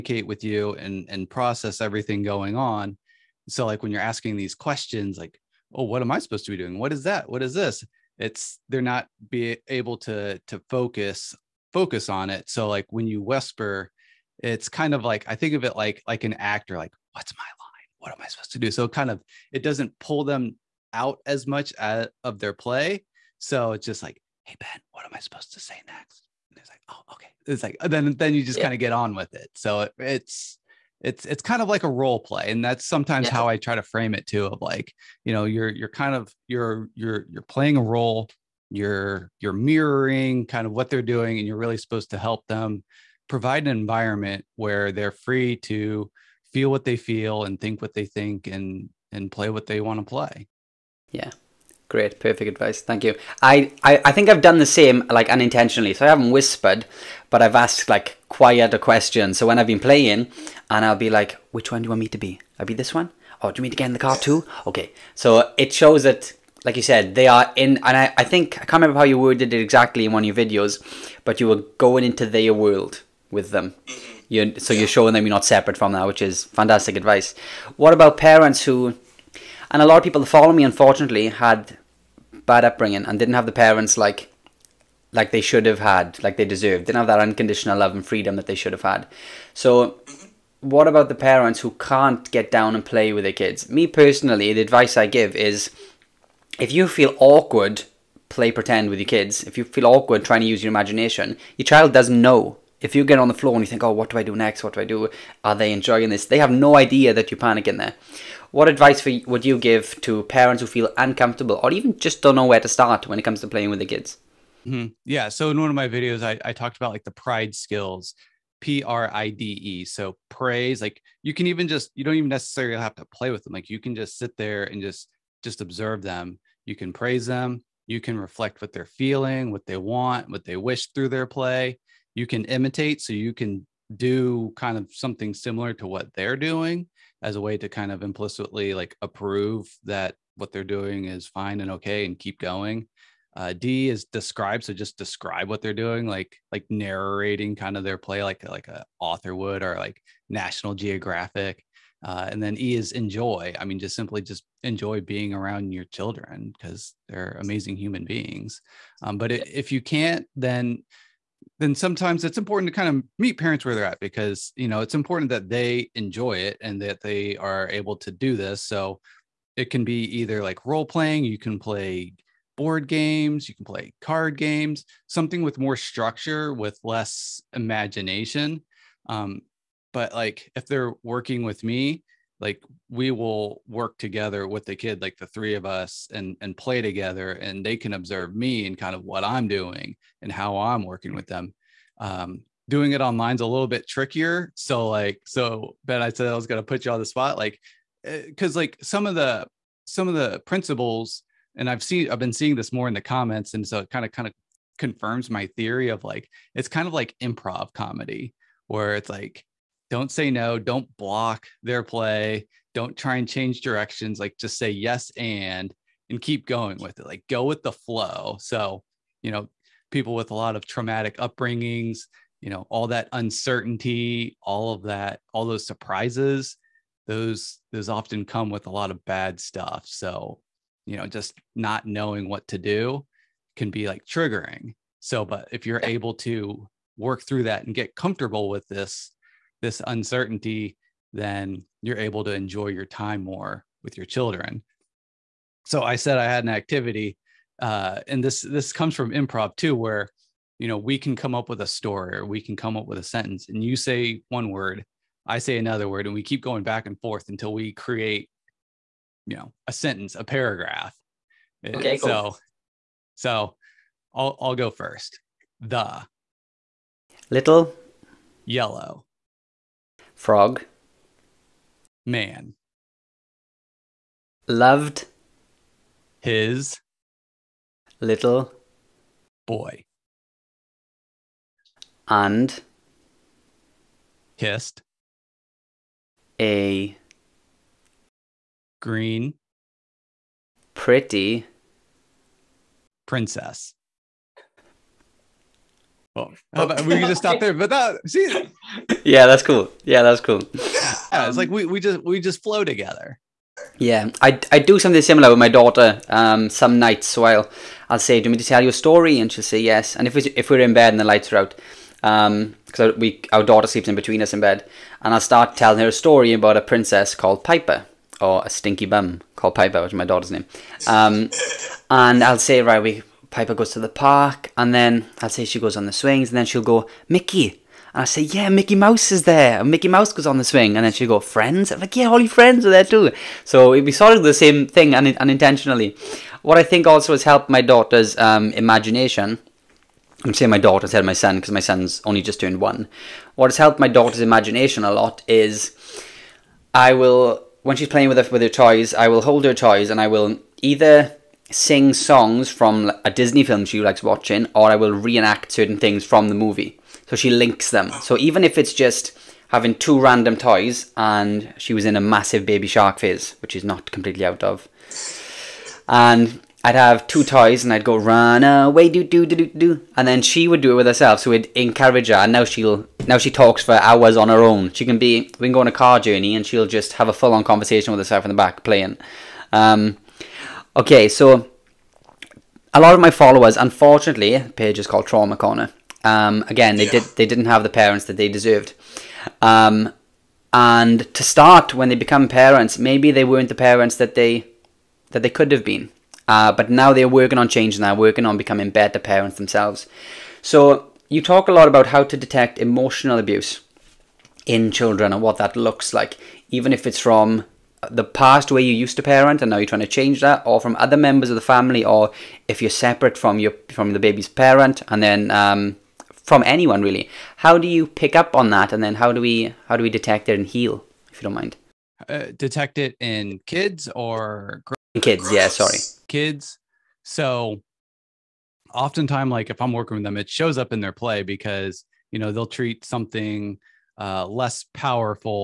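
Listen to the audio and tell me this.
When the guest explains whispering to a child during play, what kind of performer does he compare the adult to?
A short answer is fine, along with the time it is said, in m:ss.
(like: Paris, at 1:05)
An actor, at 0:16.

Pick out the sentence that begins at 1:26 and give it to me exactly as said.
Didn't have that unconditional love and freedom that they should have had.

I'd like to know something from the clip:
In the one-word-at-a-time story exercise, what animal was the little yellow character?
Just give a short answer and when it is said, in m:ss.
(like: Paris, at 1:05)
Frog, at 4:30.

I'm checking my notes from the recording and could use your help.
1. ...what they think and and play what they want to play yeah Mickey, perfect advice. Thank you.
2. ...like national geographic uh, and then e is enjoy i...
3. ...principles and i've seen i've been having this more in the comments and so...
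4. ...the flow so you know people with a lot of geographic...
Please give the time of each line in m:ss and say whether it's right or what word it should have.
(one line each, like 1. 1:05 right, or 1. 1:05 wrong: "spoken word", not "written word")
1. 0:47 wrong: "Great", not "Mickey"
2. 2:29 right
3. 3:20 wrong: "seeing", not "having"
4. 3:37 wrong: "traumatic", not "geographic".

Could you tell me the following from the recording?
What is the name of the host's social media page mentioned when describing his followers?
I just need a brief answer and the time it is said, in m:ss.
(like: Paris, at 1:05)
Trauma Corner, at 6:25.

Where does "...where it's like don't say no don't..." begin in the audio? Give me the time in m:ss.
3:28.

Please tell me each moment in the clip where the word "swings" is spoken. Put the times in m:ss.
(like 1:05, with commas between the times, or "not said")
5:25, 5:30.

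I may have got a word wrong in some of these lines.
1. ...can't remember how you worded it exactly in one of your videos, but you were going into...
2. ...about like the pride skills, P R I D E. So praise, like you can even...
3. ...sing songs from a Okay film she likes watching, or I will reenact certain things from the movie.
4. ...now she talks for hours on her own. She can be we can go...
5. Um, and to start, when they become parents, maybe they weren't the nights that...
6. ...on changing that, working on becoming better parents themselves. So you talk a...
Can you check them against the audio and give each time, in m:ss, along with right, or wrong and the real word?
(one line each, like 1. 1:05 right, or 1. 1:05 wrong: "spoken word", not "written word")
1. 1:08 right
2. 1:56 right
3. 5:51 wrong: "Disney", not "Okay"
4. 6:13 right
5. 6:29 wrong: "parents", not "nights"
6. 6:37 right.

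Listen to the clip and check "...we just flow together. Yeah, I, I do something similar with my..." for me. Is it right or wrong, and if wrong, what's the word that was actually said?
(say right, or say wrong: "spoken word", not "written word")
right.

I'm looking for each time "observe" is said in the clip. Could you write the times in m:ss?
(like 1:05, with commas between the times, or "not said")
2:05, 3:07.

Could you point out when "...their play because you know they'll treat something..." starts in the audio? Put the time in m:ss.
7:10.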